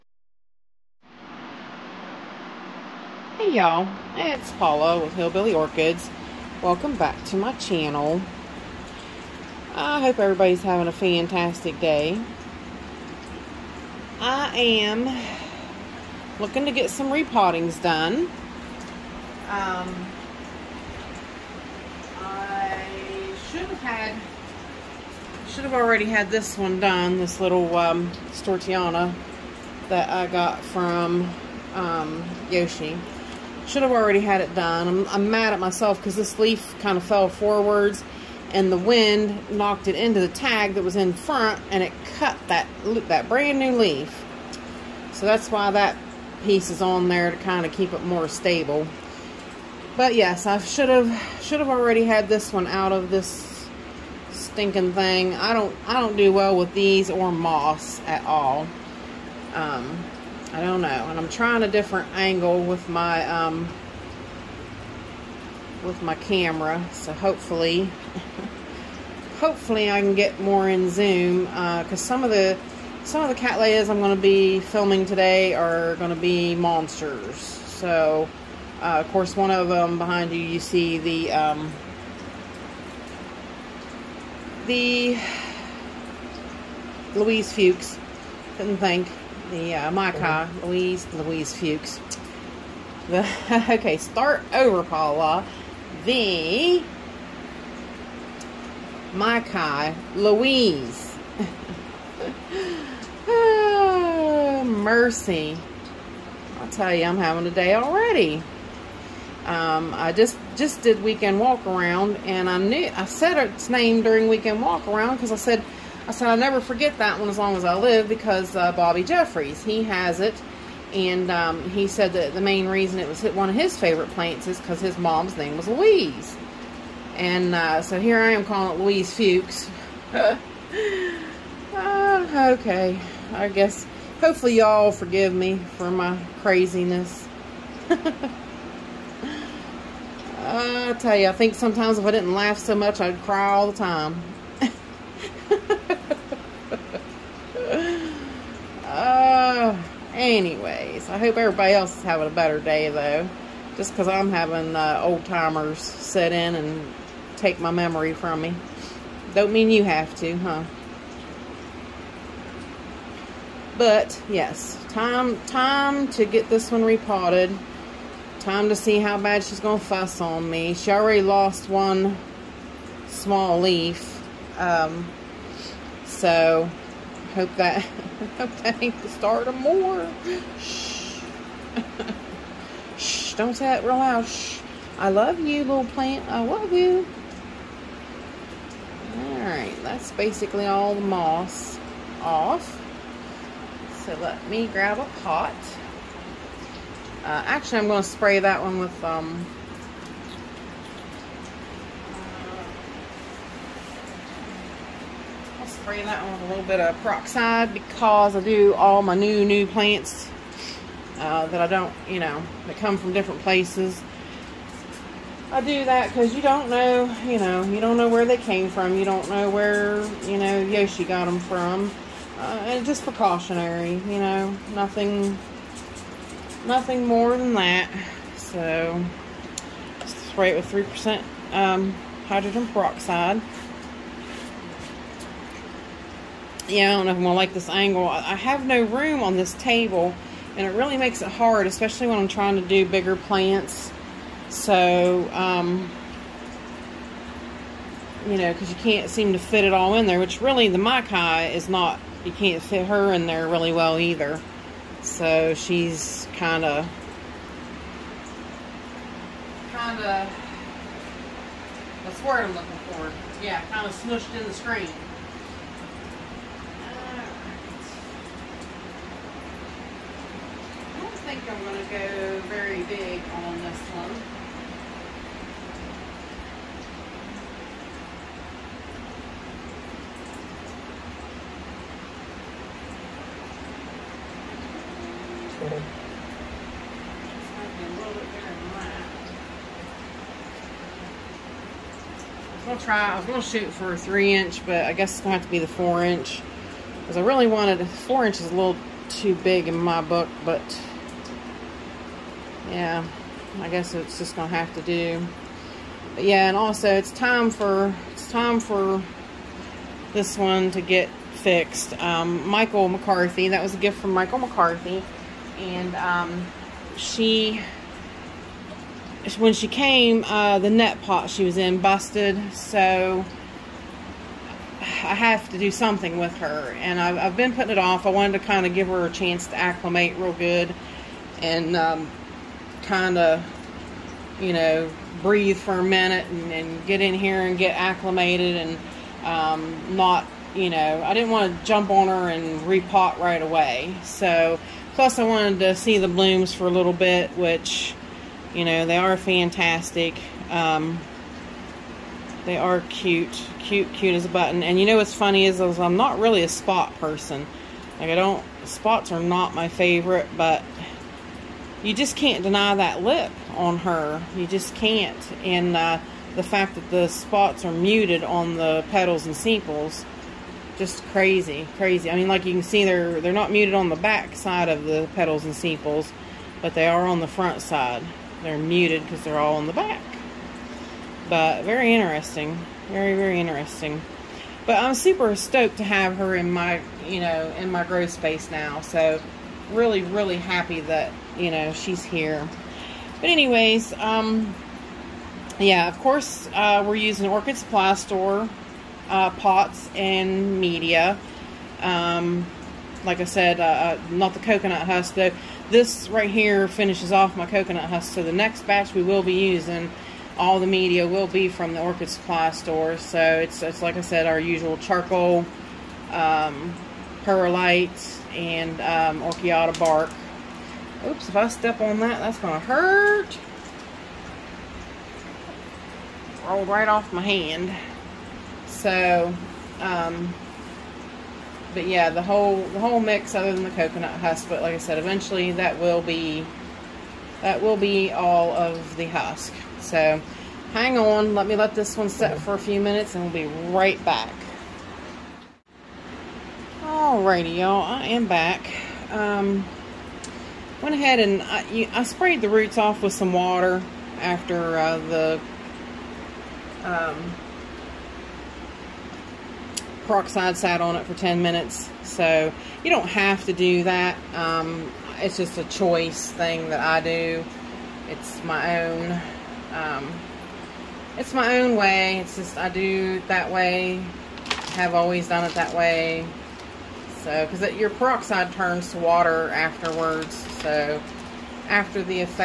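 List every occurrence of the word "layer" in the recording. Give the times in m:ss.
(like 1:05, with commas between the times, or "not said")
not said.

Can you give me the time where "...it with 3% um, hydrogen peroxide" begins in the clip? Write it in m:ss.
3:50.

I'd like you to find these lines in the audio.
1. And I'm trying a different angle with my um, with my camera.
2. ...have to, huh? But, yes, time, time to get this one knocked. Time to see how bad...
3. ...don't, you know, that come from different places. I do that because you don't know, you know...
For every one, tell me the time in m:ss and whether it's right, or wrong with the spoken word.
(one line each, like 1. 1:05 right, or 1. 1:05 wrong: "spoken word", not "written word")
1. 1:01 right
2. 2:39 wrong: "repotted", not "knocked"
3. 3:31 right.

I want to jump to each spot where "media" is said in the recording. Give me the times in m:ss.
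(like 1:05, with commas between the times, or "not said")
6:40, 6:50.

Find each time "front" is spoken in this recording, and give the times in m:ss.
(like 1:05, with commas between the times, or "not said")
0:41, 6:17.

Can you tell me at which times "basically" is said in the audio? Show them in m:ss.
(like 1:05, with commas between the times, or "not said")
3:10.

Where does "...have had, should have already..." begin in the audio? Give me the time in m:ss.
0:23.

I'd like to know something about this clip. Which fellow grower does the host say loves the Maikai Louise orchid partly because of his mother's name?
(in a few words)
Bobby Jeffries.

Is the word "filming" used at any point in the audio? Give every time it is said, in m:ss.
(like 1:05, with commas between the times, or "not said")
1:14.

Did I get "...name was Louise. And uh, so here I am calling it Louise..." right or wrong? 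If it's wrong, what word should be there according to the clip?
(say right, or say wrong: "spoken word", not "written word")
right.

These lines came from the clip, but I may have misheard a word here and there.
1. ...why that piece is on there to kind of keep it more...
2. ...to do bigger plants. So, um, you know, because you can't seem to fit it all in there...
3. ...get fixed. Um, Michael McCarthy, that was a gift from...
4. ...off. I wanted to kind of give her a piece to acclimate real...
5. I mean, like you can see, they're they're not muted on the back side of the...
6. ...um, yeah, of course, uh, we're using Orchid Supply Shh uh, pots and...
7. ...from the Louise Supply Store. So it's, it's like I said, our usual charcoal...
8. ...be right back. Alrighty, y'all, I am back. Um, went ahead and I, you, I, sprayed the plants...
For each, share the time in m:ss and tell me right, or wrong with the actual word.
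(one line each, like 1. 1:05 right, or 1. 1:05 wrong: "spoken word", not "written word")
1. 0:45 right
2. 4:02 right
3. 5:10 right
4. 5:27 wrong: "chance", not "piece"
5. 6:12 right
6. 6:33 wrong: "Store", not "Shh"
7. 6:51 wrong: "Orchid", not "Louise"
8. 7:23 wrong: "roots", not "plants".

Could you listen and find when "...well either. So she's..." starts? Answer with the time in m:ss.
4:13.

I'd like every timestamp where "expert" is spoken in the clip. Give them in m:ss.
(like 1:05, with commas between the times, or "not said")
not said.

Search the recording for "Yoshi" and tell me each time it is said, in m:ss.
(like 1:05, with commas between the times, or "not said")
0:32, 3:40.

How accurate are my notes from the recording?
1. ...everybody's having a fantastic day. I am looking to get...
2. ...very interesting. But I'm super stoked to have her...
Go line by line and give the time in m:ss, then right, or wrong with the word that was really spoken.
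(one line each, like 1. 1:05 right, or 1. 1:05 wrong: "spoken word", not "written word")
1. 0:10 right
2. 6:23 right.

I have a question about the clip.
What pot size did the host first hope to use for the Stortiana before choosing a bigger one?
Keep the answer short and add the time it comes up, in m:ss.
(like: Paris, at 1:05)
3 inch, at 4:53.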